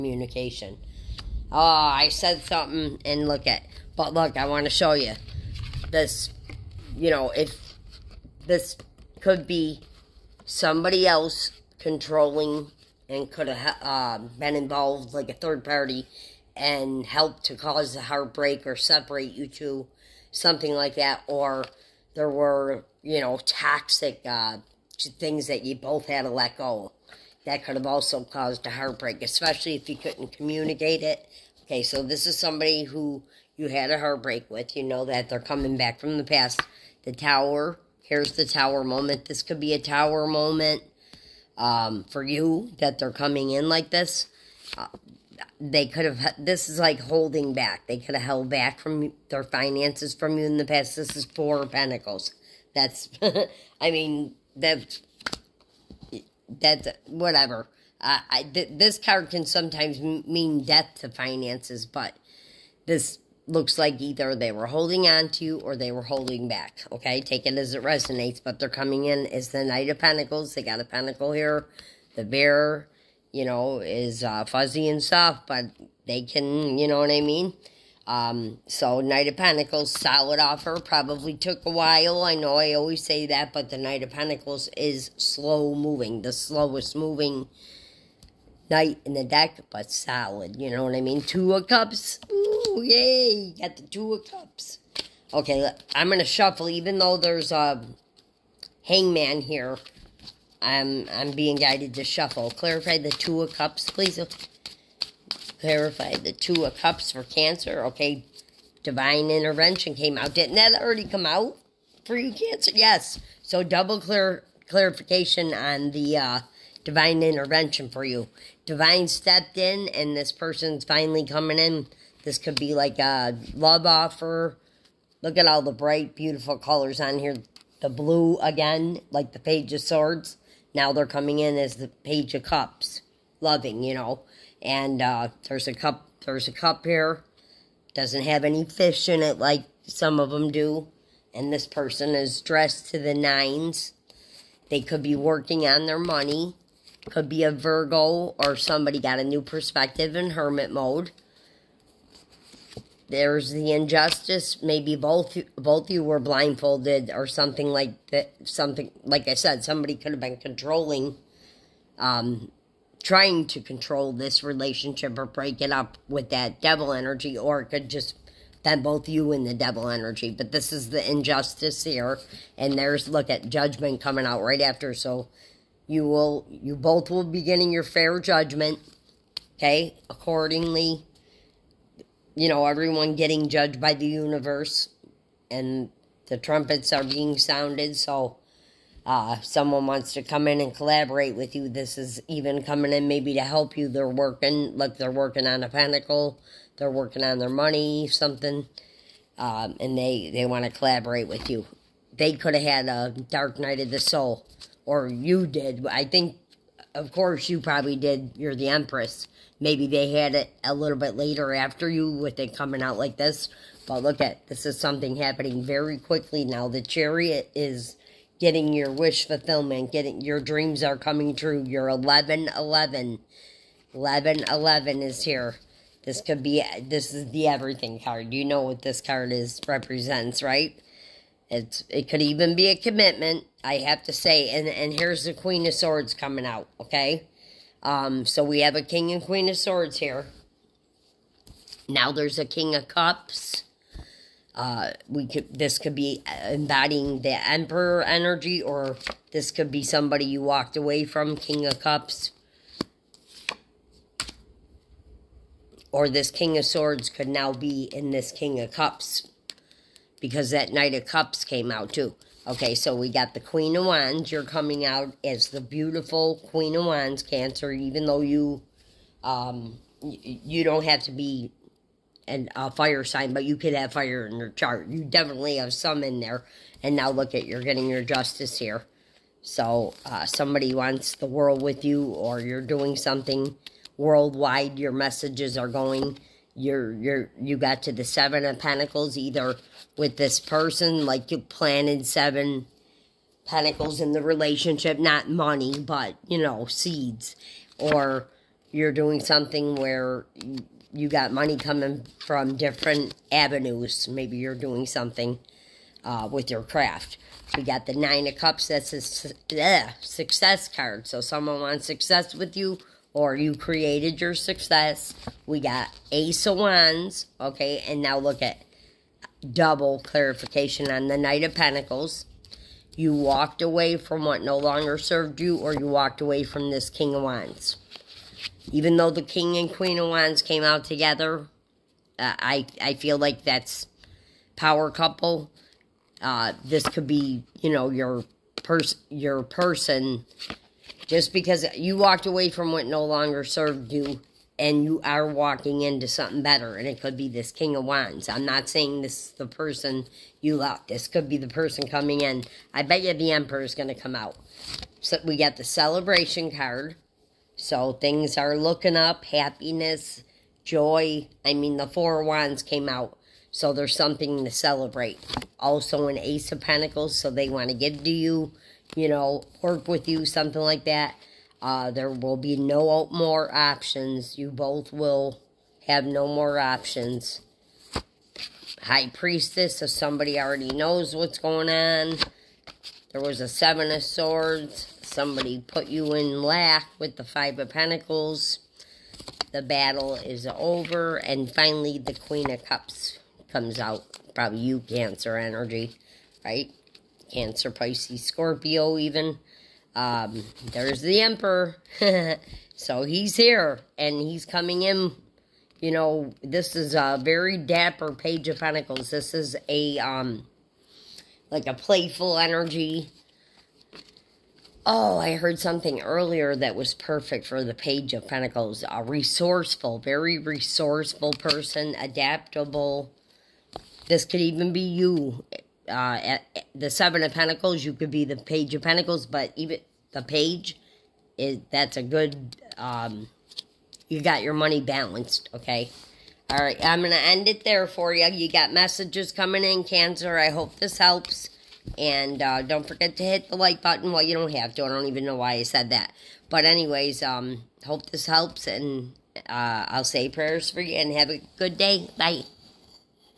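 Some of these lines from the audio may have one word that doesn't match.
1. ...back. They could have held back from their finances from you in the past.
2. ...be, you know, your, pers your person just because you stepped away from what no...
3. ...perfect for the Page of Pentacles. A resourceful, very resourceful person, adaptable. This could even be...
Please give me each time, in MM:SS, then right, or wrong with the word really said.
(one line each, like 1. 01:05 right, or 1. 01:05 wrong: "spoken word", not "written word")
1. 00:47 right
2. 05:37 wrong: "walked", not "stepped"
3. 06:56 right.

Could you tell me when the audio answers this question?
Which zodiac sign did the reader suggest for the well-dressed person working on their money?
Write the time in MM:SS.
02:27.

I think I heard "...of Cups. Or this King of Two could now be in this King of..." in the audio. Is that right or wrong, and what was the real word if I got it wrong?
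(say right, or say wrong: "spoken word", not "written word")
wrong: "Swords", not "Two".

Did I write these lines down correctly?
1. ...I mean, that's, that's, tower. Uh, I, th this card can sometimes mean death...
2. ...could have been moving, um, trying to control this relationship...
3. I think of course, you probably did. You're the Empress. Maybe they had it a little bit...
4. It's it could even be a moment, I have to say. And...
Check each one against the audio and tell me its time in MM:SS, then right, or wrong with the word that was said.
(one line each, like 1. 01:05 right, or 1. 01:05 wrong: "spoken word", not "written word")
1. 00:53 wrong: "whatever", not "tower"
2. 02:39 wrong: "controlling", not "moving"
3. 03:25 right
4. 03:51 wrong: "commitment", not "moment".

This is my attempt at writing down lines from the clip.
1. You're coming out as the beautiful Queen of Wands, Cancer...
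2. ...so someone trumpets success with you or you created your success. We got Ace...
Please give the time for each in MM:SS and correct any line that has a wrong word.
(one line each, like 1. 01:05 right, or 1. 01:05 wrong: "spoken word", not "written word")
1. 04:24 right
2. 05:11 wrong: "wants", not "trumpets".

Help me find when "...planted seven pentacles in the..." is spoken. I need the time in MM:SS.
04:51.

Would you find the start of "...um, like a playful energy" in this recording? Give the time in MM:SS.
06:49.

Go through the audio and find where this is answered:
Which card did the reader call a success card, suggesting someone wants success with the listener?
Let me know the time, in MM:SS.
05:07.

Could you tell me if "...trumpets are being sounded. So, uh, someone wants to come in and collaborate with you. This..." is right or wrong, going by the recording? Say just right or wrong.
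right.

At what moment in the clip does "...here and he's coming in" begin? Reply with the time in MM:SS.
06:43.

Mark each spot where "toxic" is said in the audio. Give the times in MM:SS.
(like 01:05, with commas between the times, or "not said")
00:23.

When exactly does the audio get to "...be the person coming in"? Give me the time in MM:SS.
05:51.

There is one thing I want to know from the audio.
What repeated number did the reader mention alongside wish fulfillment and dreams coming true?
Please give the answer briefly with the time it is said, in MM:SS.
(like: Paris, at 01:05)
11 11, at 03:41.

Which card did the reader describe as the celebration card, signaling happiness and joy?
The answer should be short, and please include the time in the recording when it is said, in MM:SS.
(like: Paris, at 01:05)
Four of Wands, at 06:01.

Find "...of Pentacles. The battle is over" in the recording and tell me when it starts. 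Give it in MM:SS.
06:27.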